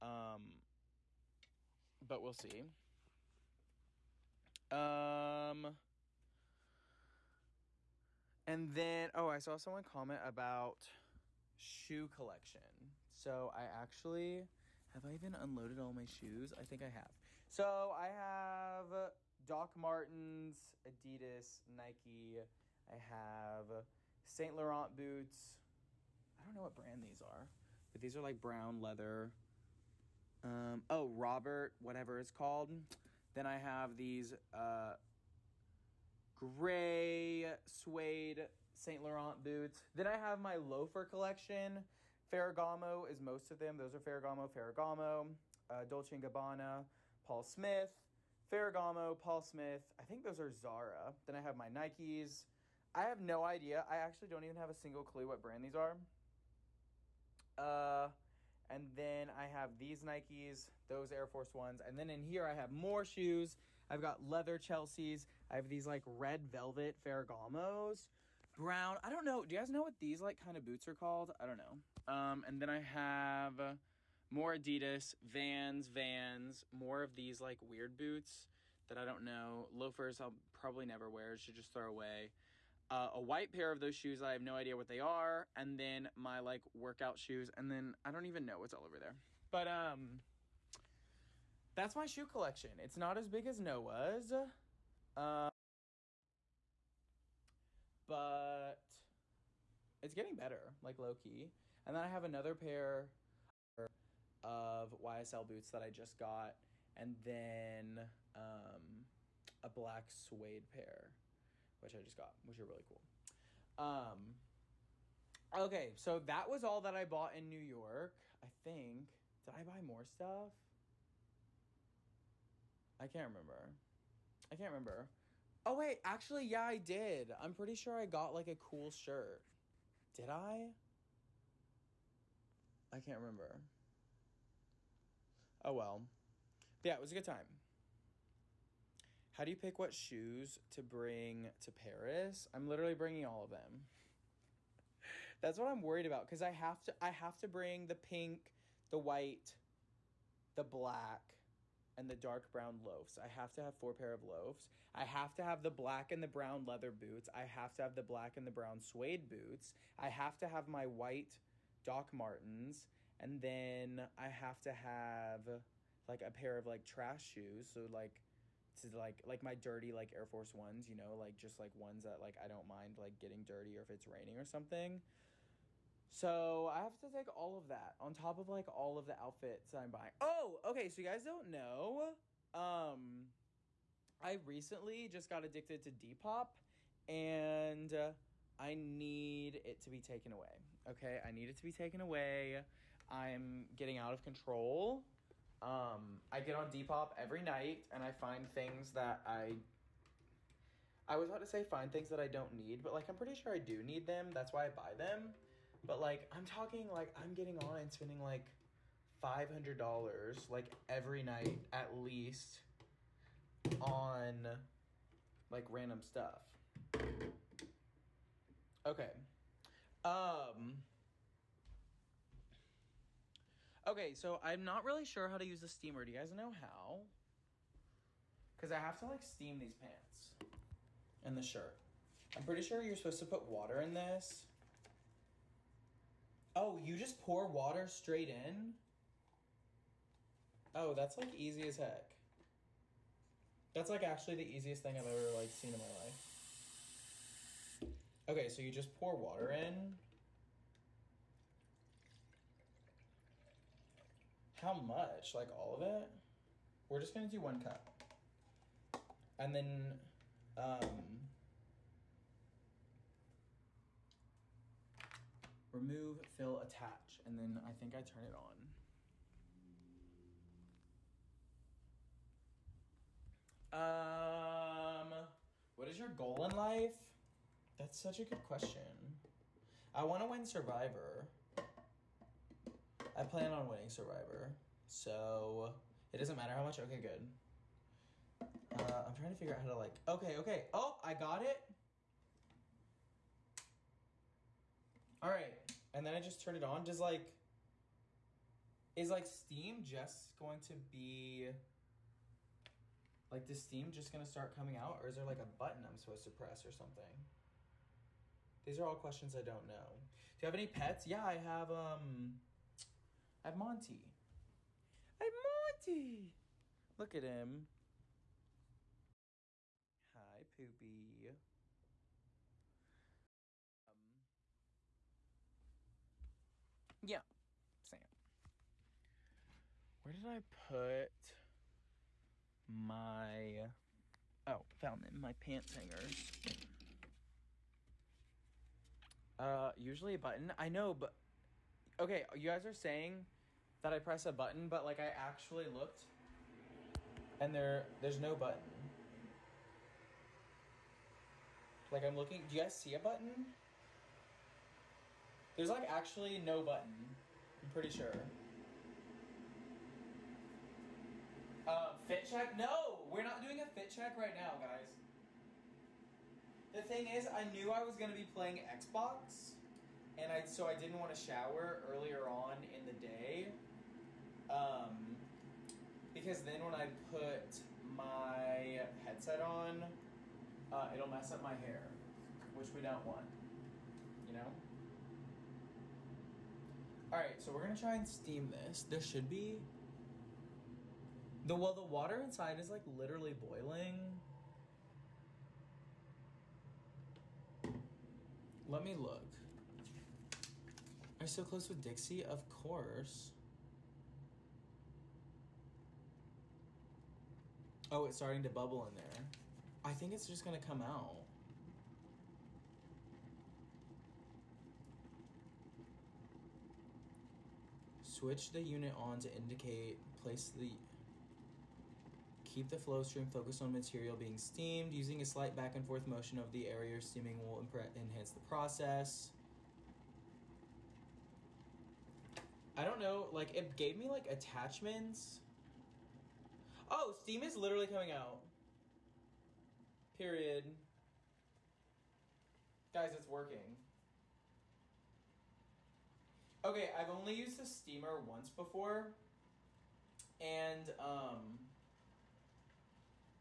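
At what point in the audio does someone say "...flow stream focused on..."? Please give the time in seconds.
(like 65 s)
422 s.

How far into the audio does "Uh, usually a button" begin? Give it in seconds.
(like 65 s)
339 s.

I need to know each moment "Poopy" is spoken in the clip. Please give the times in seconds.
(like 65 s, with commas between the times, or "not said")
320 s.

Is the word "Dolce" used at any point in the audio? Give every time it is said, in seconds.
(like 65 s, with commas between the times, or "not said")
45 s.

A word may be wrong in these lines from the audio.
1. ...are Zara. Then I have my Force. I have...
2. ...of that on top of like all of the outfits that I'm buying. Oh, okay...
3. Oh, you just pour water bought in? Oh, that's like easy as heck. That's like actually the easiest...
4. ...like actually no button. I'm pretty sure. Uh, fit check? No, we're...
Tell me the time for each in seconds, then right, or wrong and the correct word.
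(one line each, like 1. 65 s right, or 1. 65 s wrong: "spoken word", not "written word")
1. 50 s wrong: "Nikes", not "Force"
2. 177 s right
3. 236 s wrong: "straight", not "bought"
4. 355 s right.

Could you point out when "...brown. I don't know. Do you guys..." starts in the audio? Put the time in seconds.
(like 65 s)
68 s.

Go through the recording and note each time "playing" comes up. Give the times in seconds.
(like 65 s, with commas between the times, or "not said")
368 s.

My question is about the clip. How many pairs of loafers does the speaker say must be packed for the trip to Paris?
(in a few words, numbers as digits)
4.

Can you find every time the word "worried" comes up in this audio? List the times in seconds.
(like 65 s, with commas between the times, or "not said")
145 s.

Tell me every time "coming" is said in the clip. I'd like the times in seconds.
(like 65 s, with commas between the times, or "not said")
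304 s, 437 s.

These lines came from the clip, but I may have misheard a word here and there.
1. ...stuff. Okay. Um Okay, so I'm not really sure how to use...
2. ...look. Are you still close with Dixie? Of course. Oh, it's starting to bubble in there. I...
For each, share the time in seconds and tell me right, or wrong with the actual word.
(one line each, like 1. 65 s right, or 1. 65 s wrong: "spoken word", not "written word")
1. 216 s right
2. 398 s right.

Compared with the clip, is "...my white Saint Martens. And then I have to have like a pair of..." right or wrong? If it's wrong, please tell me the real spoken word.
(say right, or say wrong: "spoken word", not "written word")
wrong: "Doc", not "Saint".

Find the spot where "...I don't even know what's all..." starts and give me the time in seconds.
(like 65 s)
88 s.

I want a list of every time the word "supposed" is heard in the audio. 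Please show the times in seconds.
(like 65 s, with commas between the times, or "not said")
232 s, 305 s.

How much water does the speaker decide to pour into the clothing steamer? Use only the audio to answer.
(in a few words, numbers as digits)
One cup.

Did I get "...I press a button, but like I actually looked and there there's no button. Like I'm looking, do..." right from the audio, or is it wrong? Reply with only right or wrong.
right.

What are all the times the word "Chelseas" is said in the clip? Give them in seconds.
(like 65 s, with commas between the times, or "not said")
64 s.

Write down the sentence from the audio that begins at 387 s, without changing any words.
All right, so we're gonna try and steam this.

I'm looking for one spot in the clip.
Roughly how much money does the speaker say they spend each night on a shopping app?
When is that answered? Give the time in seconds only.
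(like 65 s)
209 s.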